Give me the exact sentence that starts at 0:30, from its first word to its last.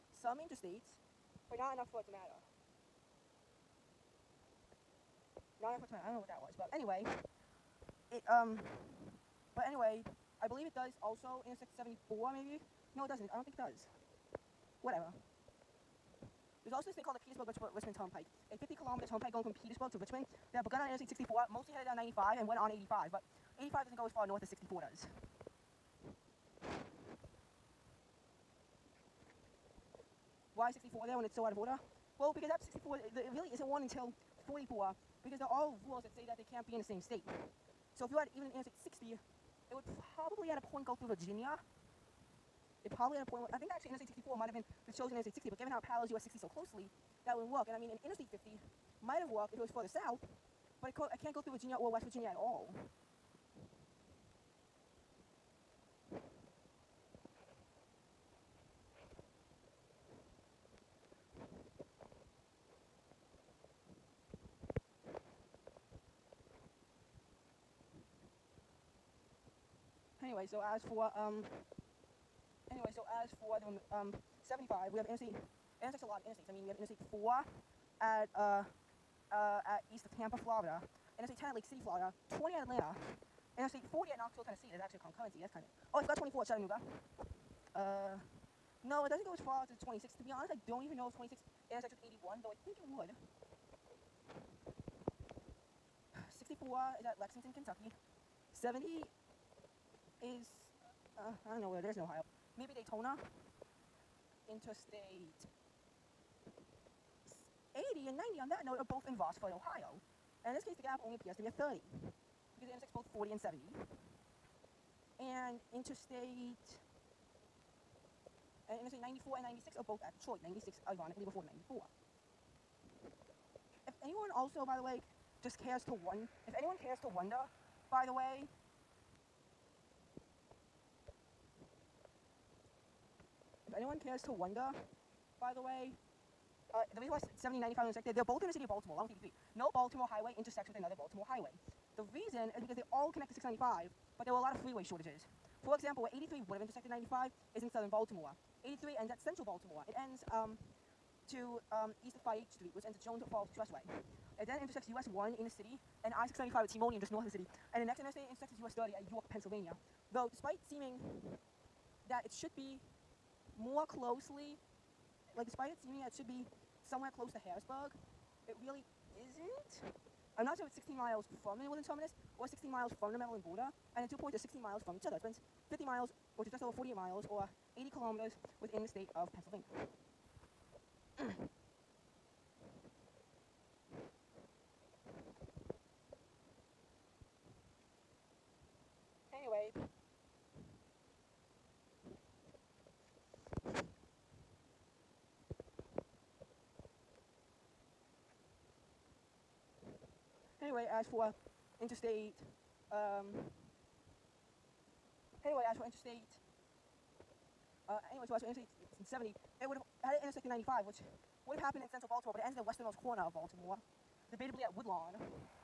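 Why 64 there when it's so out of order?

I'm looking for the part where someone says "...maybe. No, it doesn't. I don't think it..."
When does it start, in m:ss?
0:12.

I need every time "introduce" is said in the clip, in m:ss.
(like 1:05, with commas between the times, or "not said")
not said.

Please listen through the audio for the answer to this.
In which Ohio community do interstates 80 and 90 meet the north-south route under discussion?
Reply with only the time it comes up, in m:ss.
1:49.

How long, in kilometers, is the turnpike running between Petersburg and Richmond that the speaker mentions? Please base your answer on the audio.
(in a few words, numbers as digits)
50 kilometers.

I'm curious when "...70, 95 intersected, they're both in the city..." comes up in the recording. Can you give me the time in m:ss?
2:17.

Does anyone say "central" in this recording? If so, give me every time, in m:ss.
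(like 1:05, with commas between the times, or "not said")
2:29, 3:31.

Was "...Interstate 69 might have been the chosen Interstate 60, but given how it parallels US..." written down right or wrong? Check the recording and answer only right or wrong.
wrong.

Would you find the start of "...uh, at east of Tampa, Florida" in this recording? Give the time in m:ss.
1:19.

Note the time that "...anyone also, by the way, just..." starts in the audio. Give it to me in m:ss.
2:04.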